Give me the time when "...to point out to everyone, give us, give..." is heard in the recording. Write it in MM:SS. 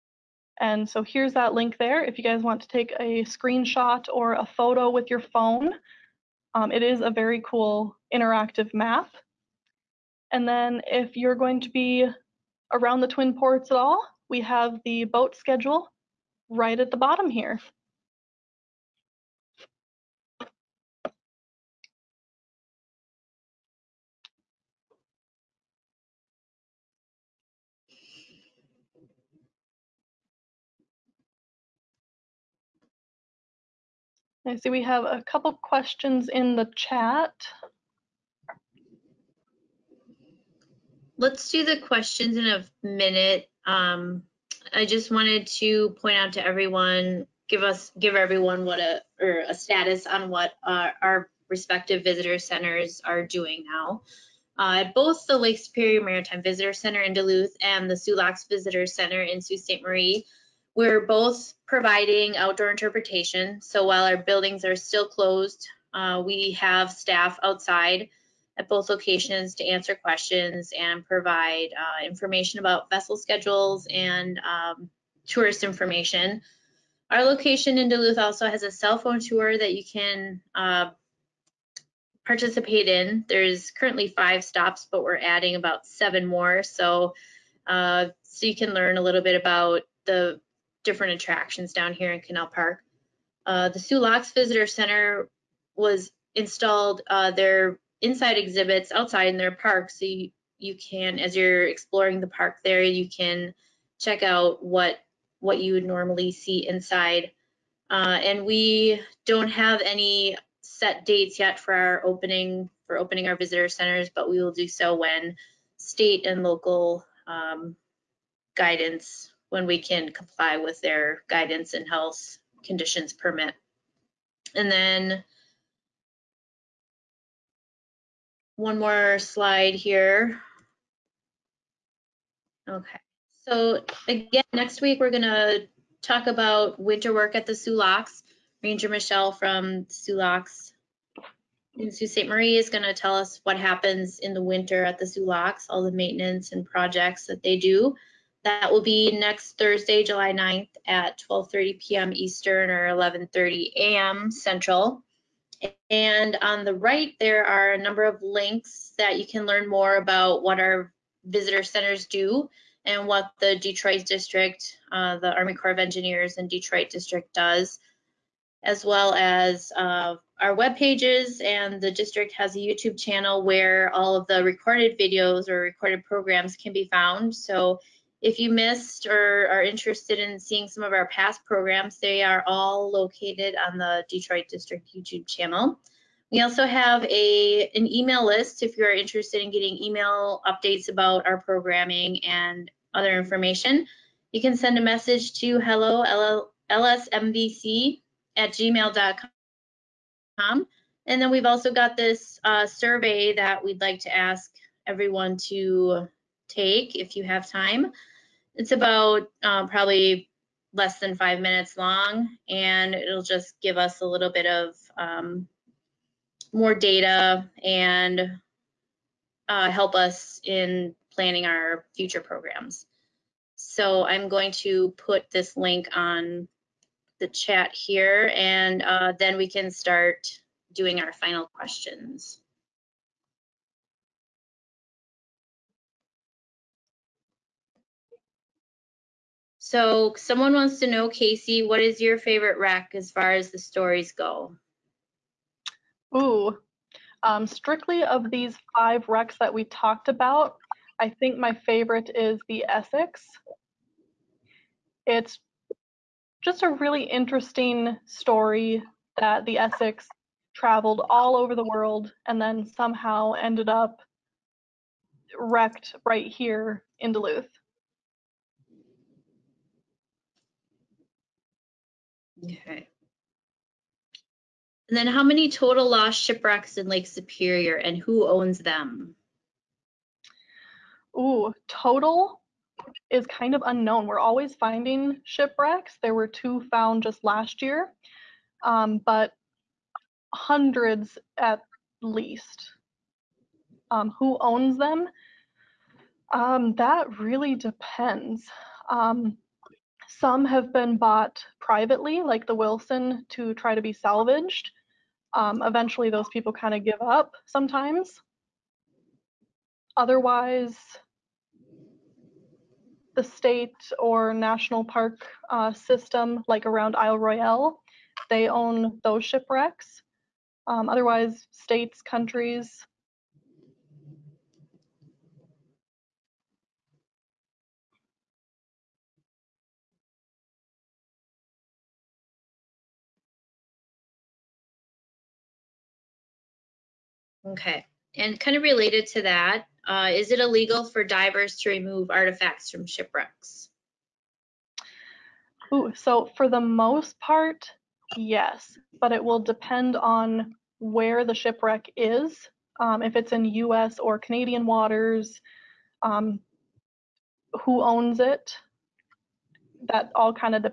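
00:45.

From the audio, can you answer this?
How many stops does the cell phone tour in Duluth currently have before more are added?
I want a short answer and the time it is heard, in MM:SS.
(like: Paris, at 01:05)
5, at 01:24.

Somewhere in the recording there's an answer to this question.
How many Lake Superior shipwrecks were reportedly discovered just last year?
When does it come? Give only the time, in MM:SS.
04:46.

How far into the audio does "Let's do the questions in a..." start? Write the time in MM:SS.
00:41.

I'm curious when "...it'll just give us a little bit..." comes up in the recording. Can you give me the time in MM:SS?
03:32.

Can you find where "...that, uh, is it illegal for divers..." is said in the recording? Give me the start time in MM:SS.
05:39.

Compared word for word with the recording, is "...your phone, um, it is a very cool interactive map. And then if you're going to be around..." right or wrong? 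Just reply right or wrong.
right.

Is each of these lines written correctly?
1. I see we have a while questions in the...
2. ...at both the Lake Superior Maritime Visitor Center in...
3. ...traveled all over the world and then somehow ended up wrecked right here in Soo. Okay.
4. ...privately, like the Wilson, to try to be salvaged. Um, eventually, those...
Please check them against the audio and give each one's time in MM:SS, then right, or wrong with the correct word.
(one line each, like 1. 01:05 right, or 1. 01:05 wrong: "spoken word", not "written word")
1. 00:34 wrong: "couple", not "while"
2. 00:54 right
3. 04:20 wrong: "Duluth", not "Soo"
4. 05:01 right.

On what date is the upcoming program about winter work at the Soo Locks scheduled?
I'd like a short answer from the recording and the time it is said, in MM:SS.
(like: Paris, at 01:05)
July 9th, at 02:30.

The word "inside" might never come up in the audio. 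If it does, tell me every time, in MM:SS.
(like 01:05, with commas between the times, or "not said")
01:38, 01:46.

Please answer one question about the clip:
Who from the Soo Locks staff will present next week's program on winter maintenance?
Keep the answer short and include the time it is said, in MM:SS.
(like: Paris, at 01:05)
Ranger Michelle, at 02:18.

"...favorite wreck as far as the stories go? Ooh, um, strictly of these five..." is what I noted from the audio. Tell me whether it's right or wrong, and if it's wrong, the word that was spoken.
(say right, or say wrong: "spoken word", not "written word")
right.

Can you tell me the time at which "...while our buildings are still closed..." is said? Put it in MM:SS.
01:03.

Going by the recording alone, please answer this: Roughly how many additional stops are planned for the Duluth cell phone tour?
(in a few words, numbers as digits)
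7.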